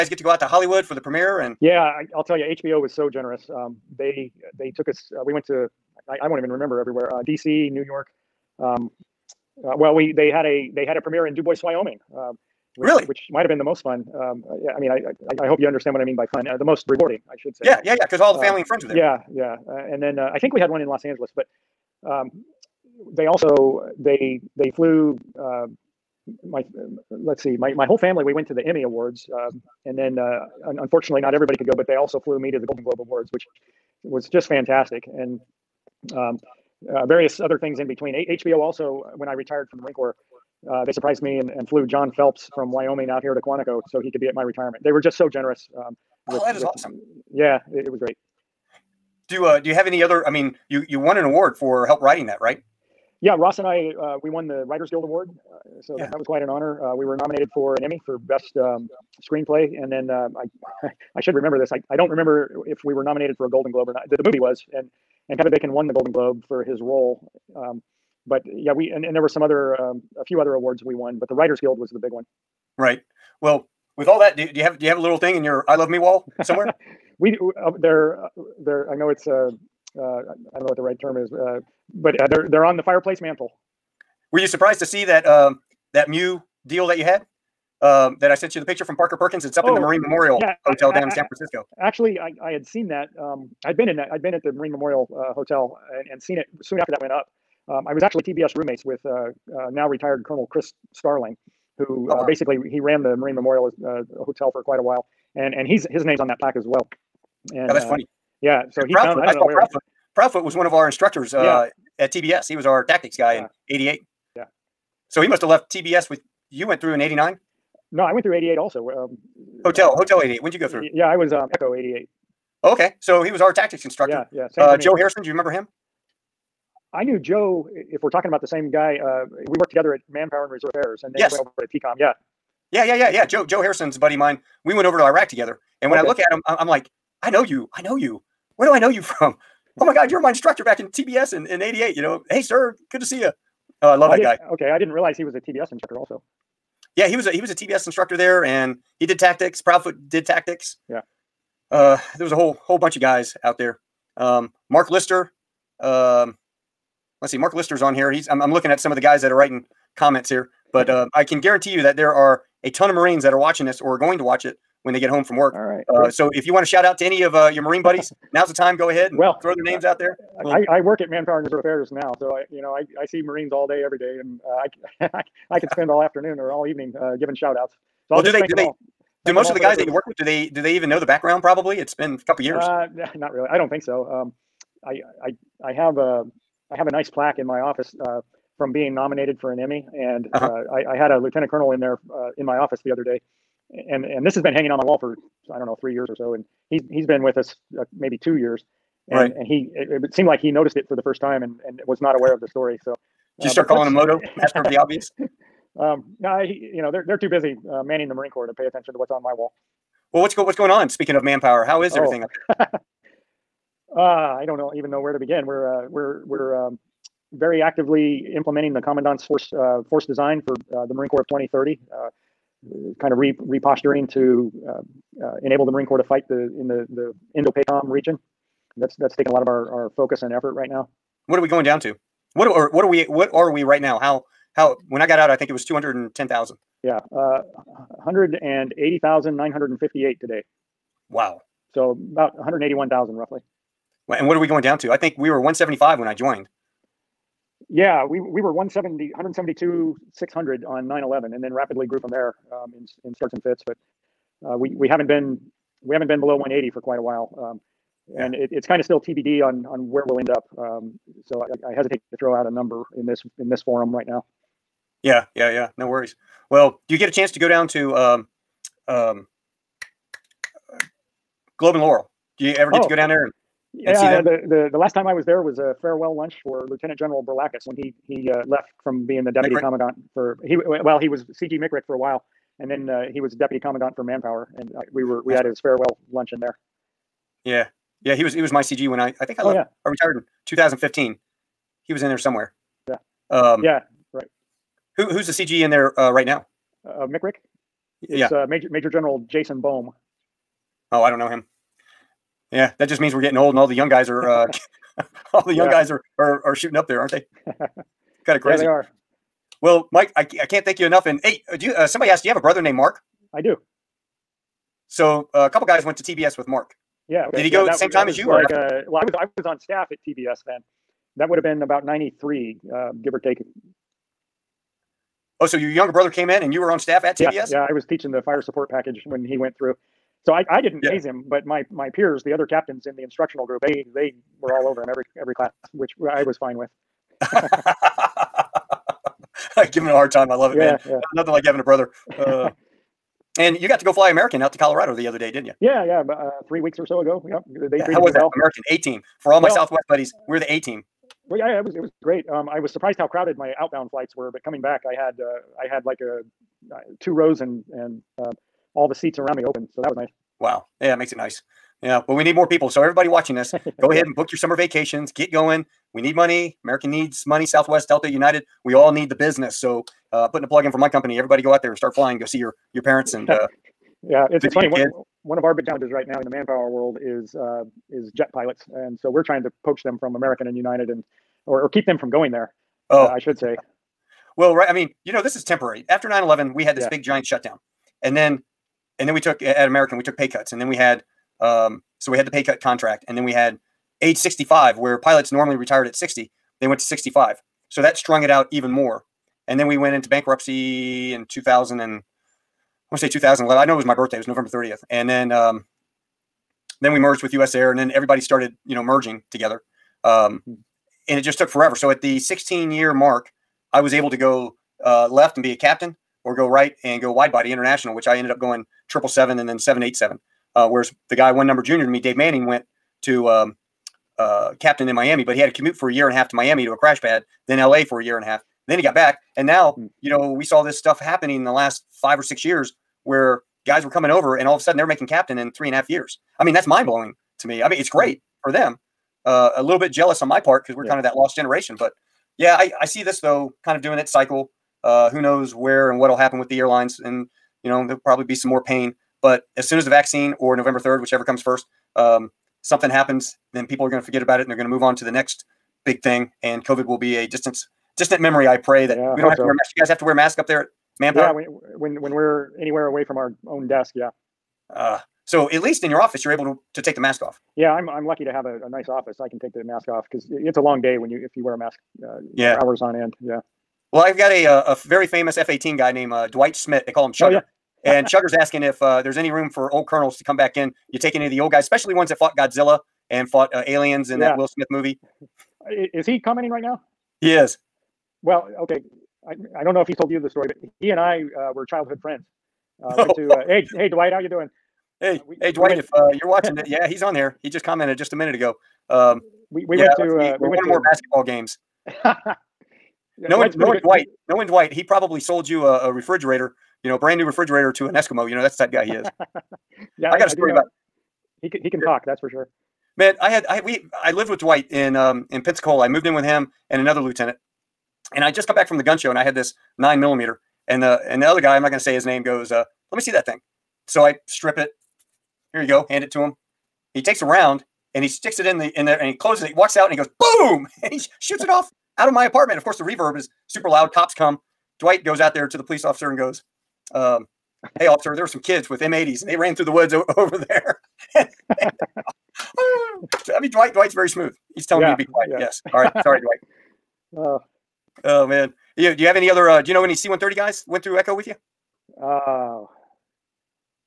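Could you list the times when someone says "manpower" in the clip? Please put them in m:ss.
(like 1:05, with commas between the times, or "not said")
2:10, 2:51, 3:31, 4:44, 6:16, 7:40.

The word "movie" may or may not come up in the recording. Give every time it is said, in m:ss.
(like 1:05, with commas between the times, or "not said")
1:04, 8:04.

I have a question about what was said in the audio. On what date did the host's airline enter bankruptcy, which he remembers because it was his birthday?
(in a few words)
November 30th.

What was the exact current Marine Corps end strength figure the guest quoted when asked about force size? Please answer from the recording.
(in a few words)
180,958.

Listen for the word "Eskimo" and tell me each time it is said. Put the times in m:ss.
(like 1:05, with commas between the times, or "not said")
8:27.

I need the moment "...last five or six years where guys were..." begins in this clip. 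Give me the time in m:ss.
7:11.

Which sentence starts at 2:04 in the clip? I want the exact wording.
Uh, Joe Harrison, do you remember him?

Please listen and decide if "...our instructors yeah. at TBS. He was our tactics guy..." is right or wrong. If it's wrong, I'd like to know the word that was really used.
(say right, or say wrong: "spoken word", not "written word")
right.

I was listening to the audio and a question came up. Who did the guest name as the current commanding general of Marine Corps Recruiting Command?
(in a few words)
Jason Bohm.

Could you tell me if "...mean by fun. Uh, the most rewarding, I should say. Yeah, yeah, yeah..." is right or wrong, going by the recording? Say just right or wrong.
right.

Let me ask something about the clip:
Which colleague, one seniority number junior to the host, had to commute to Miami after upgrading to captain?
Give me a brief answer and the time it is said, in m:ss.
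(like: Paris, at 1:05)
Dave Manning, at 7:01.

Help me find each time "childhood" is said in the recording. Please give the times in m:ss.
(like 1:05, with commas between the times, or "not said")
8:11.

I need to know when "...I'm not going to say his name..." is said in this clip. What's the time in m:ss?
8:41.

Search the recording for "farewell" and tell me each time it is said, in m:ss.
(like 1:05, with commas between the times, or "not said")
4:35, 4:45.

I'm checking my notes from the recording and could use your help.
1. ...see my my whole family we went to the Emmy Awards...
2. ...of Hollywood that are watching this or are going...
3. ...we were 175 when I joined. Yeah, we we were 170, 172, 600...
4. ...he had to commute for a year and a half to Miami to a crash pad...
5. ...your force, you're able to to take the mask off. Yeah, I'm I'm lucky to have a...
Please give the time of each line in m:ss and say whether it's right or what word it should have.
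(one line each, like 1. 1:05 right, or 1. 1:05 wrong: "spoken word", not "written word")
1. 0:27 right
2. 2:42 wrong: "Marines", not "Hollywood"
3. 4:05 right
4. 7:05 right
5. 7:45 wrong: "office", not "force".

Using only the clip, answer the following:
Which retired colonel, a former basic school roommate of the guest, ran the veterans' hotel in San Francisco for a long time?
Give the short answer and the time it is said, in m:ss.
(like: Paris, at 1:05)
Chris Starling, at 1:40.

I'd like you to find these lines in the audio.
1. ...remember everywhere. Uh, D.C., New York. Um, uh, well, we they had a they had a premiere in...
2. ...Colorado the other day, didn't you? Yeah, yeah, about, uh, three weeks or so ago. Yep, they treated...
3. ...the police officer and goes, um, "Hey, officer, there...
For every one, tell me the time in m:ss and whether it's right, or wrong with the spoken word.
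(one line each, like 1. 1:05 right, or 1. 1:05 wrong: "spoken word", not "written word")
1. 0:06 right
2. 5:44 right
3. 8:55 right.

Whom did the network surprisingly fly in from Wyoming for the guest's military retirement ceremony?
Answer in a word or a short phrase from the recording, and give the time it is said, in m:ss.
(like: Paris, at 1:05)
John Phelps, at 0:41.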